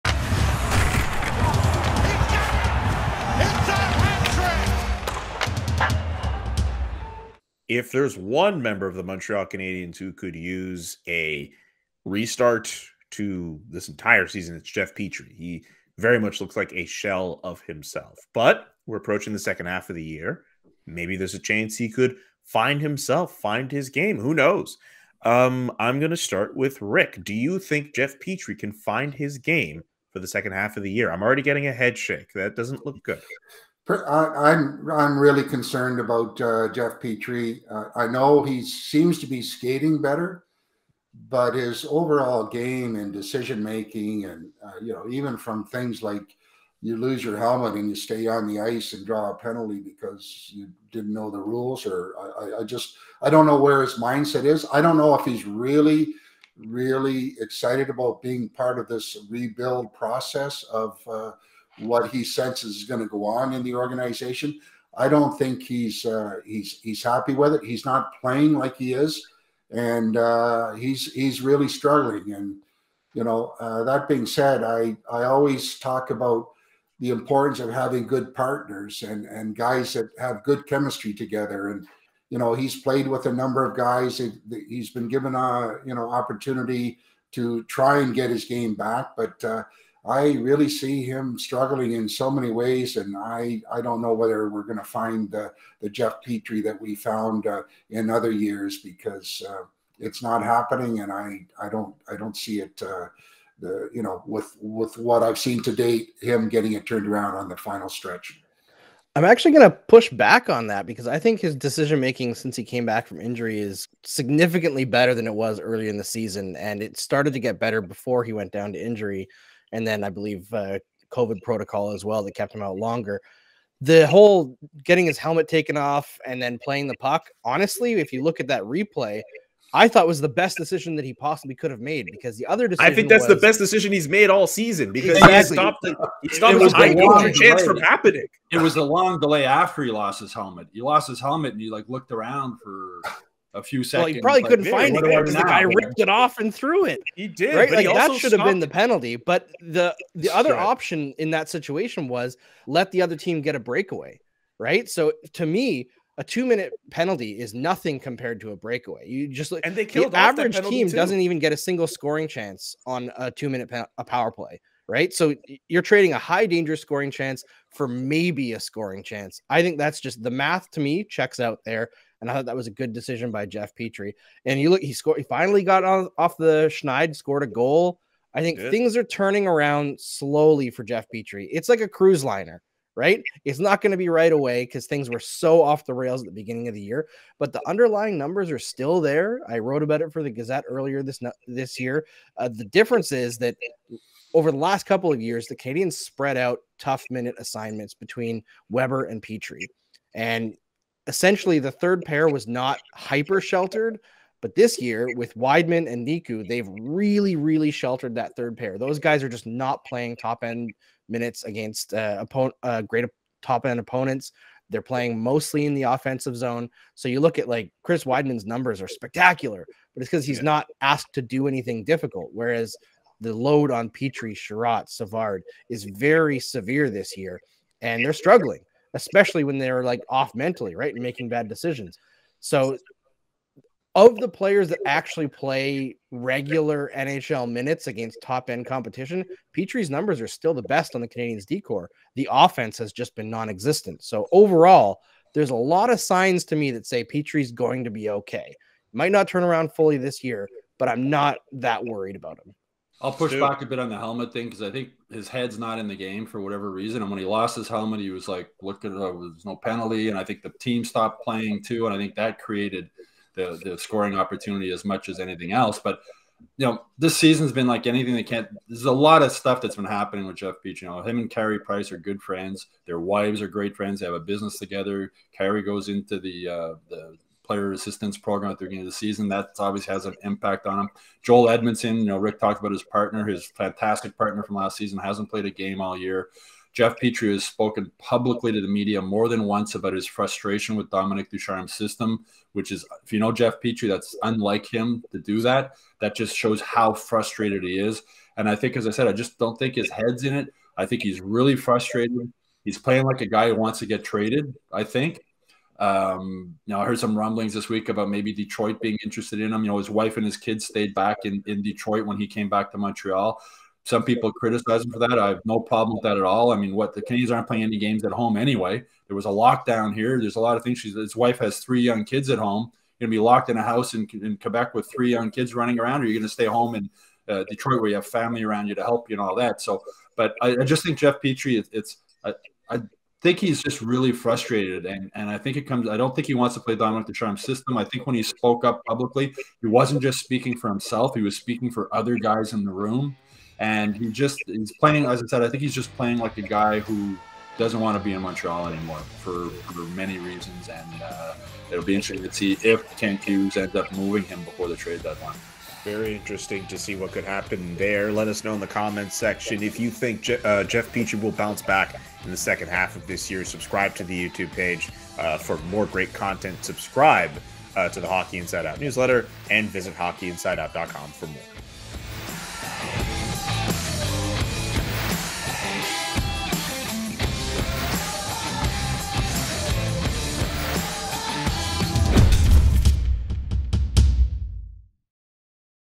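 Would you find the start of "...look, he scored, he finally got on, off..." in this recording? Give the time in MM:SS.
02:54.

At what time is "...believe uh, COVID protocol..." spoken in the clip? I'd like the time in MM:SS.
02:00.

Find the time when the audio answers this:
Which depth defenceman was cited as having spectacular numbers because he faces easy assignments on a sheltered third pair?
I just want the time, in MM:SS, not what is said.
03:37.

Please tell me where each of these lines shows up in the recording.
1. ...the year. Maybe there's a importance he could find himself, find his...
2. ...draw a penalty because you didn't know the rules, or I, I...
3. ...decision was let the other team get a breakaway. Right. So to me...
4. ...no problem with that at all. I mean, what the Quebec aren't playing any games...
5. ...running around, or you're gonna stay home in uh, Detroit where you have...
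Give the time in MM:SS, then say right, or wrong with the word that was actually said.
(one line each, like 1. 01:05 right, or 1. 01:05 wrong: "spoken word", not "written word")
1. 00:19 wrong: "chance", not "importance"
2. 00:49 right
3. 02:31 wrong: "situation", not "decision"
4. 05:15 wrong: "Canadiens", not "Quebec"
5. 05:25 right.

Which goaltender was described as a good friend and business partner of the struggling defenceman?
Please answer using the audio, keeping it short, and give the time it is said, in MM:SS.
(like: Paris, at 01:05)
Carey Price, at 04:31.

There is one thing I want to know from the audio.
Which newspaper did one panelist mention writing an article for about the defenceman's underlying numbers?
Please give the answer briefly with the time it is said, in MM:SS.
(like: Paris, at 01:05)
The Gazette, at 03:10.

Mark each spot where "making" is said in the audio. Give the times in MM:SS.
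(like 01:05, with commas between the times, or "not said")
00:43, 01:51, 03:51.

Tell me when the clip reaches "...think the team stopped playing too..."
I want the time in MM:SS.
04:20.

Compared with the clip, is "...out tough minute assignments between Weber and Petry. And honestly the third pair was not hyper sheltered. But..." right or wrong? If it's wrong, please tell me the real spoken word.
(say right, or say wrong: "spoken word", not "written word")
wrong: "essentially", not "honestly".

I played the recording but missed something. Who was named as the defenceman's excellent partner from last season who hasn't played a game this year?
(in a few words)
Joel Edmundson.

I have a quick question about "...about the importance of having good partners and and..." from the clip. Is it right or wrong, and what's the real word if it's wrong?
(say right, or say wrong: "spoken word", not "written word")
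right.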